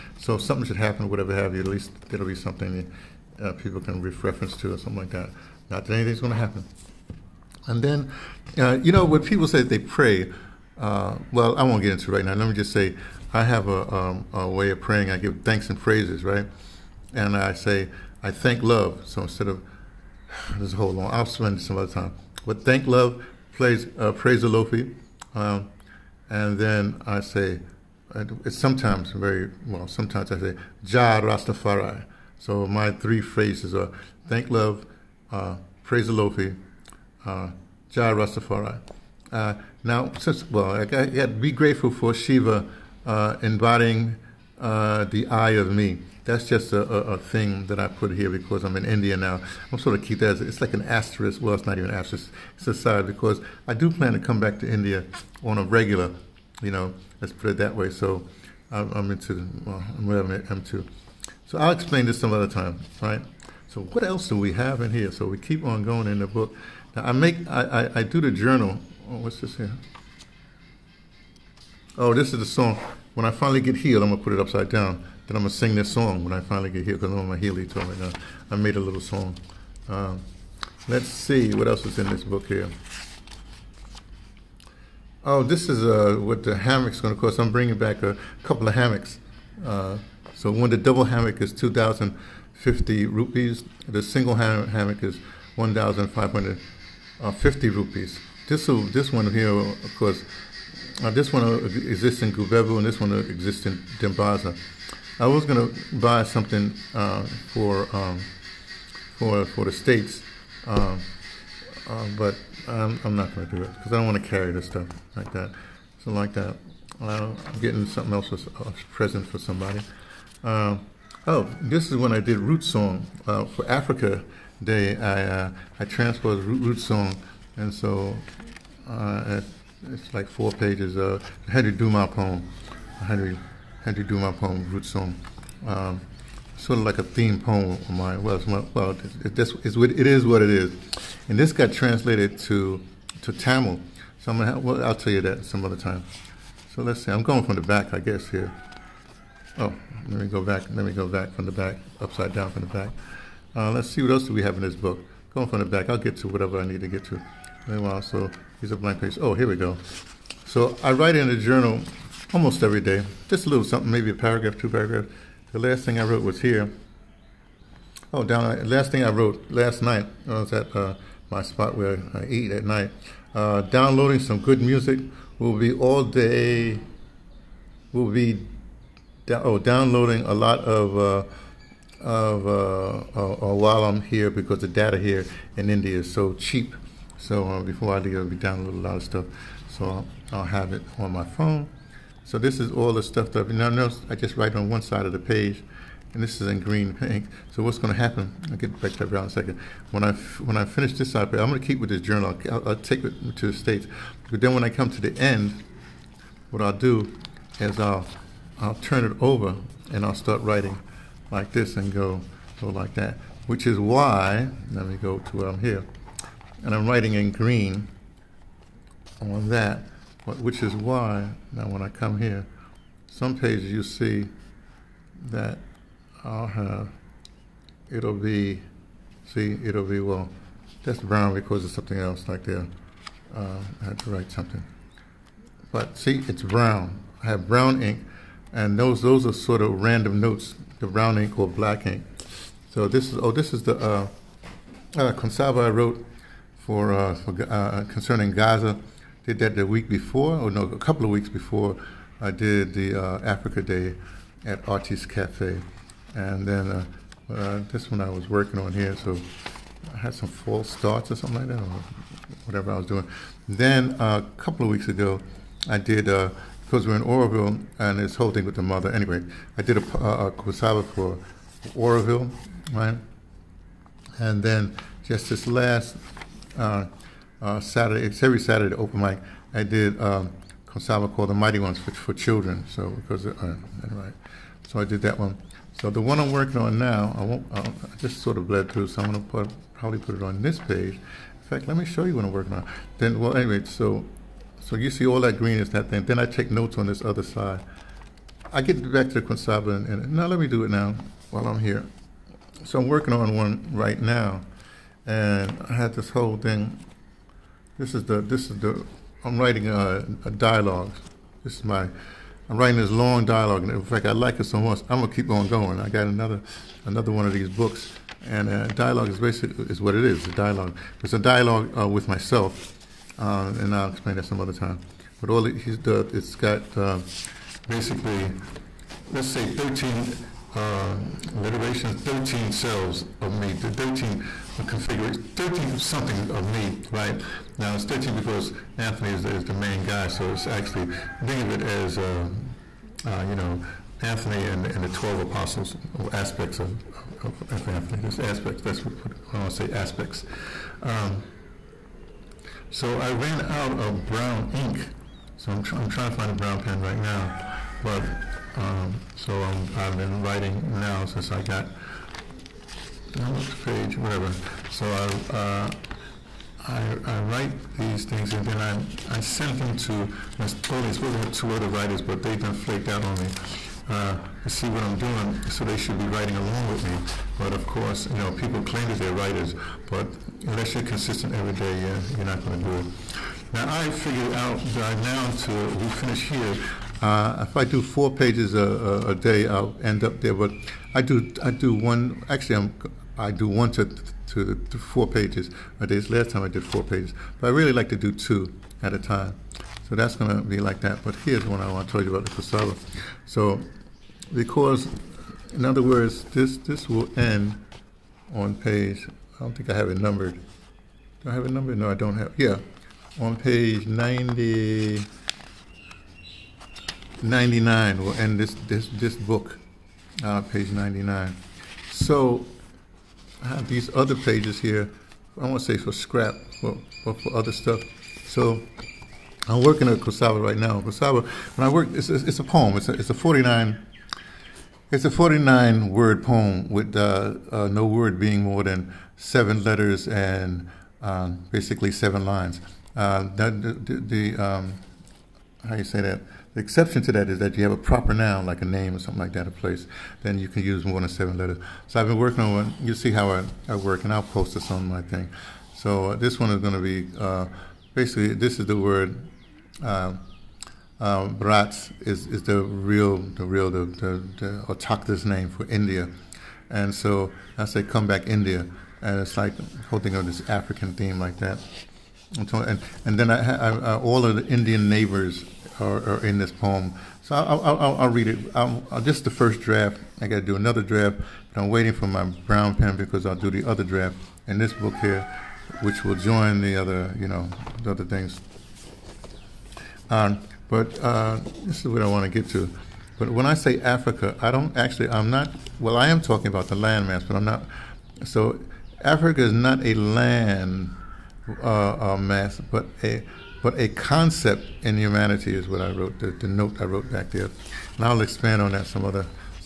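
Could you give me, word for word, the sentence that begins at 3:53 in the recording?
Uh, I had to write something.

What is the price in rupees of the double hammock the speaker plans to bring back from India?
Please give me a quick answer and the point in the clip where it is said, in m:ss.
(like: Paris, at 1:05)
2050 rupees, at 1:31.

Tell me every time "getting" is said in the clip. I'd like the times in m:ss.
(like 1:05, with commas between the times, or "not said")
1:57.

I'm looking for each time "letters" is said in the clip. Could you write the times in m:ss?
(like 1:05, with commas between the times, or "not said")
7:19, 7:31.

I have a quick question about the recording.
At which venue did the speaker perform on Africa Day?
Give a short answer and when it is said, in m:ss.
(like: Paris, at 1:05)
Artis Cafe, at 4:14.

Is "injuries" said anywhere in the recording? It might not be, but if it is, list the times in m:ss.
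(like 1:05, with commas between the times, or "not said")
not said.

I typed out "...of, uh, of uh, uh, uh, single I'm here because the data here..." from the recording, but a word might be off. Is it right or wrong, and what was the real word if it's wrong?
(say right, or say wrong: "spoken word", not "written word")
wrong: "while", not "single".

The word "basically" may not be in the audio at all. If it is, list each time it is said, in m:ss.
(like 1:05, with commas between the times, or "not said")
5:19, 5:27, 7:21, 7:37.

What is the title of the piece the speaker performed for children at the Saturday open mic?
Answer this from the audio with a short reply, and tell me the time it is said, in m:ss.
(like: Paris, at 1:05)
The Mighty Ones, at 4:41.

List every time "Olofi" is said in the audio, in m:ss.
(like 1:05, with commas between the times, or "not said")
0:24, 0:36.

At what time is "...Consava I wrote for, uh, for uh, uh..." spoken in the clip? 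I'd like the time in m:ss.
4:05.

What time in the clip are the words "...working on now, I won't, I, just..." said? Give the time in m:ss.
4:46.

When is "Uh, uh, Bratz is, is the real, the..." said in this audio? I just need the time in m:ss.
7:39.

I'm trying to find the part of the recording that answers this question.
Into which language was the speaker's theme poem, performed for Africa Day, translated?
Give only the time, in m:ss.
2:23.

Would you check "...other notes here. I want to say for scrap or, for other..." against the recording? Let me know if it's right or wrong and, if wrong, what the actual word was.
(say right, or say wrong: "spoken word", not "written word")
wrong: "pages", not "notes".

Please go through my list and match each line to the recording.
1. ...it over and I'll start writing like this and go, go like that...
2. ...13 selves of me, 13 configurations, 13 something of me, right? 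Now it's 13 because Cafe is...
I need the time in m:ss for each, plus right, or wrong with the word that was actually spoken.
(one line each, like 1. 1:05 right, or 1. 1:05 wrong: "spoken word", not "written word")
1. 3:29 right
2. 5:32 wrong: "Anthony", not "Cafe".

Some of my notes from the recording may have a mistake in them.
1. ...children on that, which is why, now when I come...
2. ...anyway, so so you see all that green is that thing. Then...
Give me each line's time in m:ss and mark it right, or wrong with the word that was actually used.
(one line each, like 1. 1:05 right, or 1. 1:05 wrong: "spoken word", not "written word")
1. 3:37 wrong: "green", not "children"
2. 4:53 right.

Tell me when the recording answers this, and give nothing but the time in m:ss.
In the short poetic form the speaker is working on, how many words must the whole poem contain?
7:15.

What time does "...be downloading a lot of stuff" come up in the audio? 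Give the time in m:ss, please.
3:08.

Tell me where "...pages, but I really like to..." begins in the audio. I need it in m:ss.
6:36.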